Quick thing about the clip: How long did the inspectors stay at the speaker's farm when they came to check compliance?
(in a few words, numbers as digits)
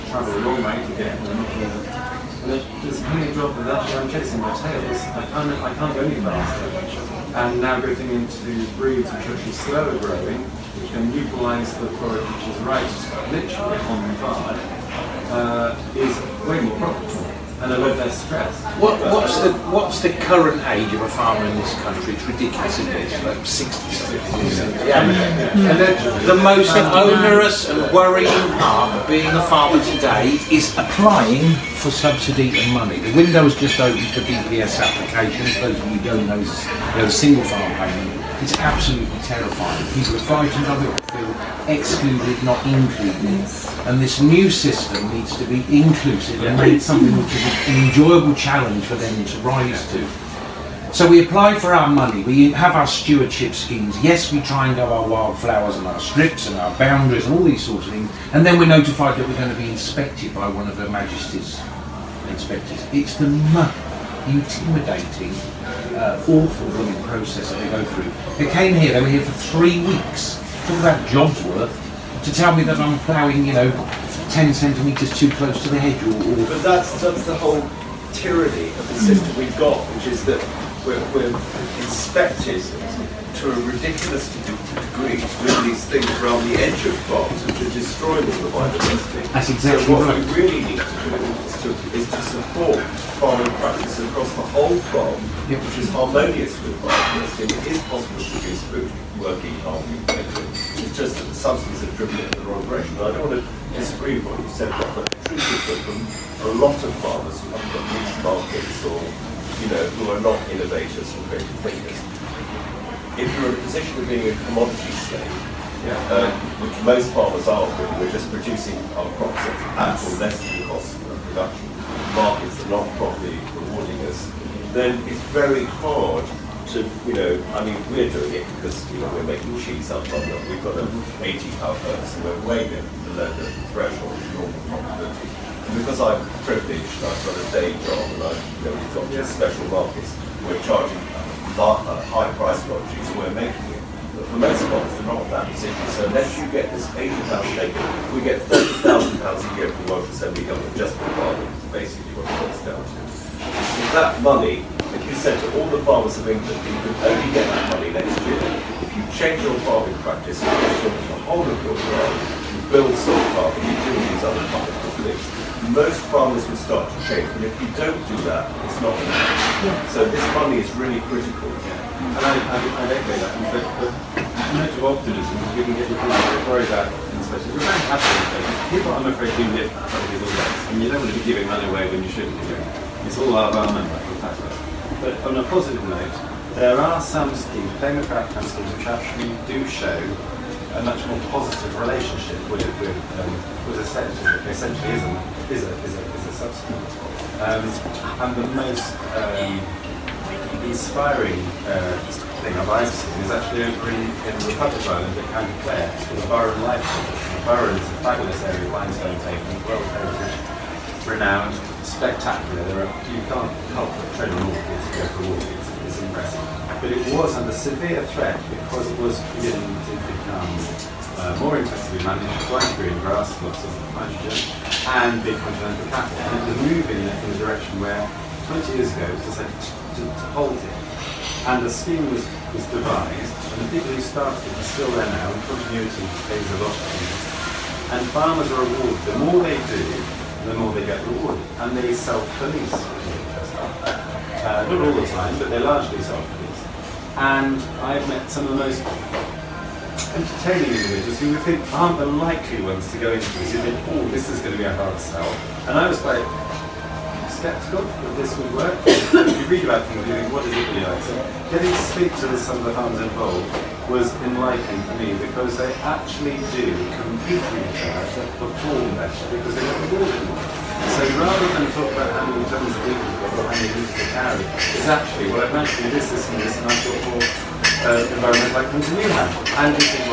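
three weeks.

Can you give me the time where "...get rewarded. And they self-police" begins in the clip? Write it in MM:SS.
04:00.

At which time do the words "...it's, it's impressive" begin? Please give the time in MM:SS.
03:35.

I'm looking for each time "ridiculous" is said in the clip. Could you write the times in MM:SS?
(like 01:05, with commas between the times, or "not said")
00:22, 01:23.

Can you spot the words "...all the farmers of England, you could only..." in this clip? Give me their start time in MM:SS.
02:35.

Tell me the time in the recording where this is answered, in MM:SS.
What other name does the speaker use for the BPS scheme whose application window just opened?
00:37.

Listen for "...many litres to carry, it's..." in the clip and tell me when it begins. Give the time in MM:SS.
04:33.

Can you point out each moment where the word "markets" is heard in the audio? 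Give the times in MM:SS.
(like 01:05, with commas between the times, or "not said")
01:48, 02:02, 02:19.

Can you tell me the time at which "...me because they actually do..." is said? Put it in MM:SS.
04:24.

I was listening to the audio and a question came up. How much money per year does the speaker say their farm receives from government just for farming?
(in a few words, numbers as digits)
£30,000.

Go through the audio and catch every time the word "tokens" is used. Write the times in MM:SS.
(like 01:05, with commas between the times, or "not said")
not said.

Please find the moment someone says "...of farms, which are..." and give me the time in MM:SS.
01:26.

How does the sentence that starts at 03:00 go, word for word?
and you don't want to be giving money away when you shouldn't be doing.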